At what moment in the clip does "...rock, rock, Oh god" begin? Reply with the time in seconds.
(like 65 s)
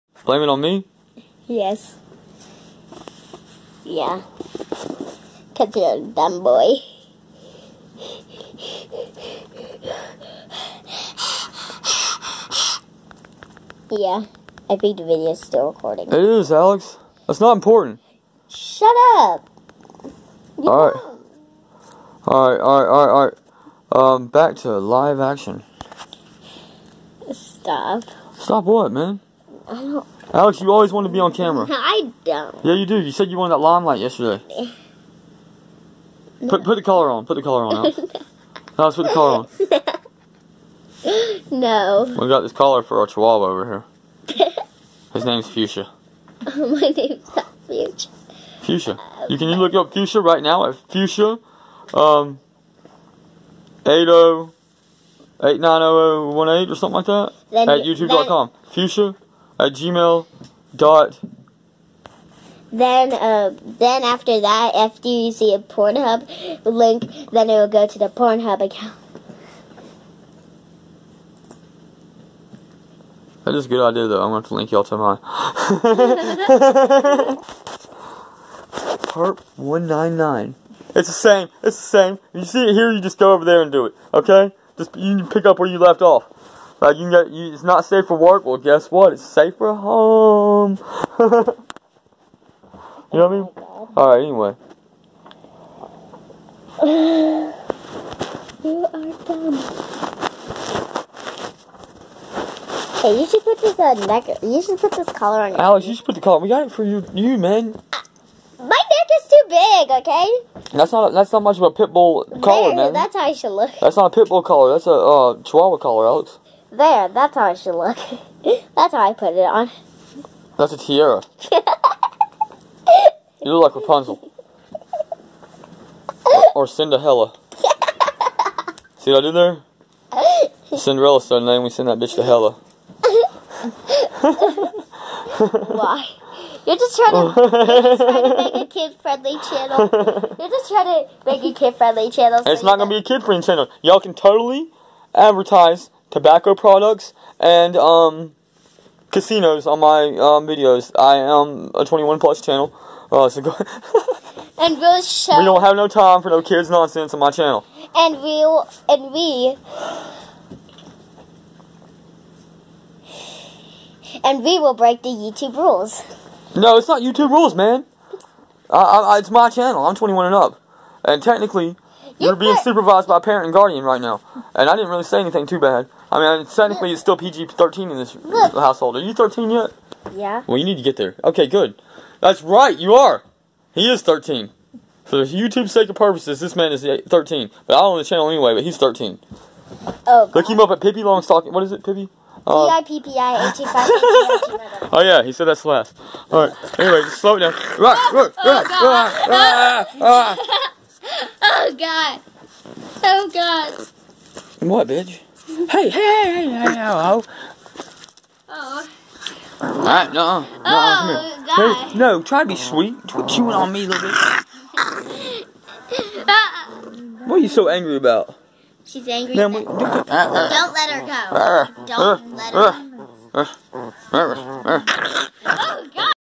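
198 s.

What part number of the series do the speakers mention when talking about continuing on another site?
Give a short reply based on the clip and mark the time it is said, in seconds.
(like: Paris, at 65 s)
199, at 79 s.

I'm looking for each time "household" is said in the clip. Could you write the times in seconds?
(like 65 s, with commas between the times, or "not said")
178 s.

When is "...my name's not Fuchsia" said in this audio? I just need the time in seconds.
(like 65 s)
46 s.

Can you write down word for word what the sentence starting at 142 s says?
So it's not going to be a kid-friendly channel.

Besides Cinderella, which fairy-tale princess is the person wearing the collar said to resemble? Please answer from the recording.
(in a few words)
Rapunzel.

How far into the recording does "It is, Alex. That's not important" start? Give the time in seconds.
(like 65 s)
16 s.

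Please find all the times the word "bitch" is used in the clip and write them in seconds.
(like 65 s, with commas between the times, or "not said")
131 s, 204 s.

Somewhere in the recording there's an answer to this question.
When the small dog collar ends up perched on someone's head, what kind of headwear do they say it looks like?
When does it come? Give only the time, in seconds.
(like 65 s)
120 s.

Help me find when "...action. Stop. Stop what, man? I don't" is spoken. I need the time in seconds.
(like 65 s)
25 s.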